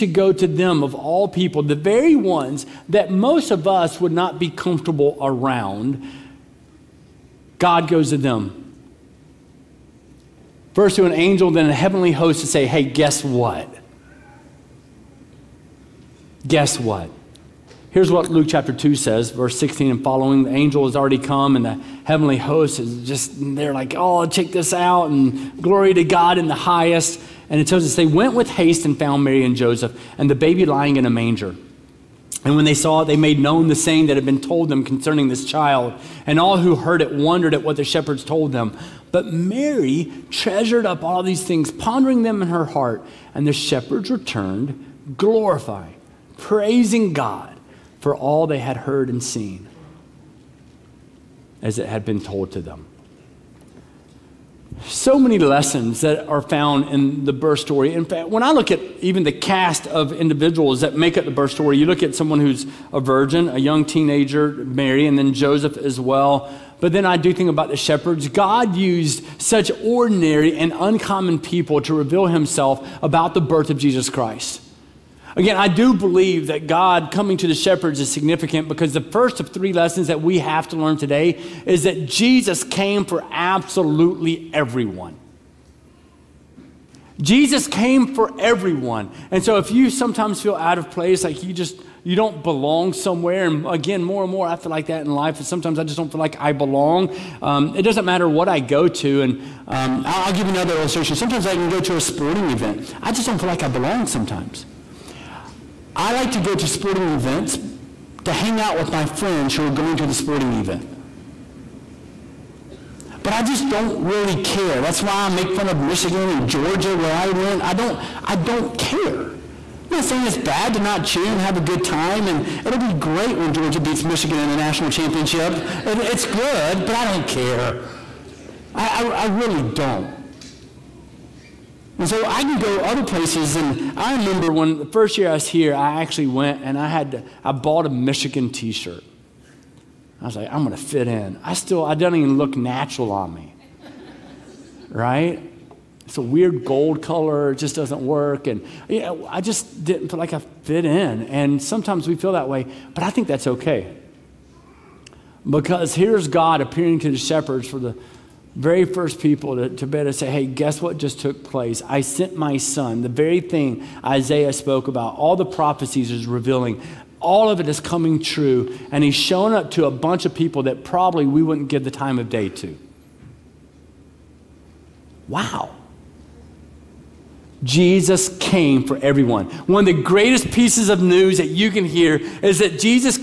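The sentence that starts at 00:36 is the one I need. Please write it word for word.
And all who heard it wondered at what the shepherds told them.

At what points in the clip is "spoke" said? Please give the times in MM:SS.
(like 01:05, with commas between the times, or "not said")
02:44.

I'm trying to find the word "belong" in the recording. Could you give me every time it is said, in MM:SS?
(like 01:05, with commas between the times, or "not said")
01:32, 01:36, 01:43.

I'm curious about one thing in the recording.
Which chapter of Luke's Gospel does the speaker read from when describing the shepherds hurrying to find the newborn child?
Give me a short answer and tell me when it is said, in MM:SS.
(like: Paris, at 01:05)
Chapter 2, at 00:18.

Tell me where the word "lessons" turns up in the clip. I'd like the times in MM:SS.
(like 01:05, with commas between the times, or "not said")
00:55, 01:19.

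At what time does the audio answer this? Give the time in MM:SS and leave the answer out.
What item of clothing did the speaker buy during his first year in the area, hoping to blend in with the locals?
02:17.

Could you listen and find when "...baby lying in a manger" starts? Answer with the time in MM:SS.
00:30.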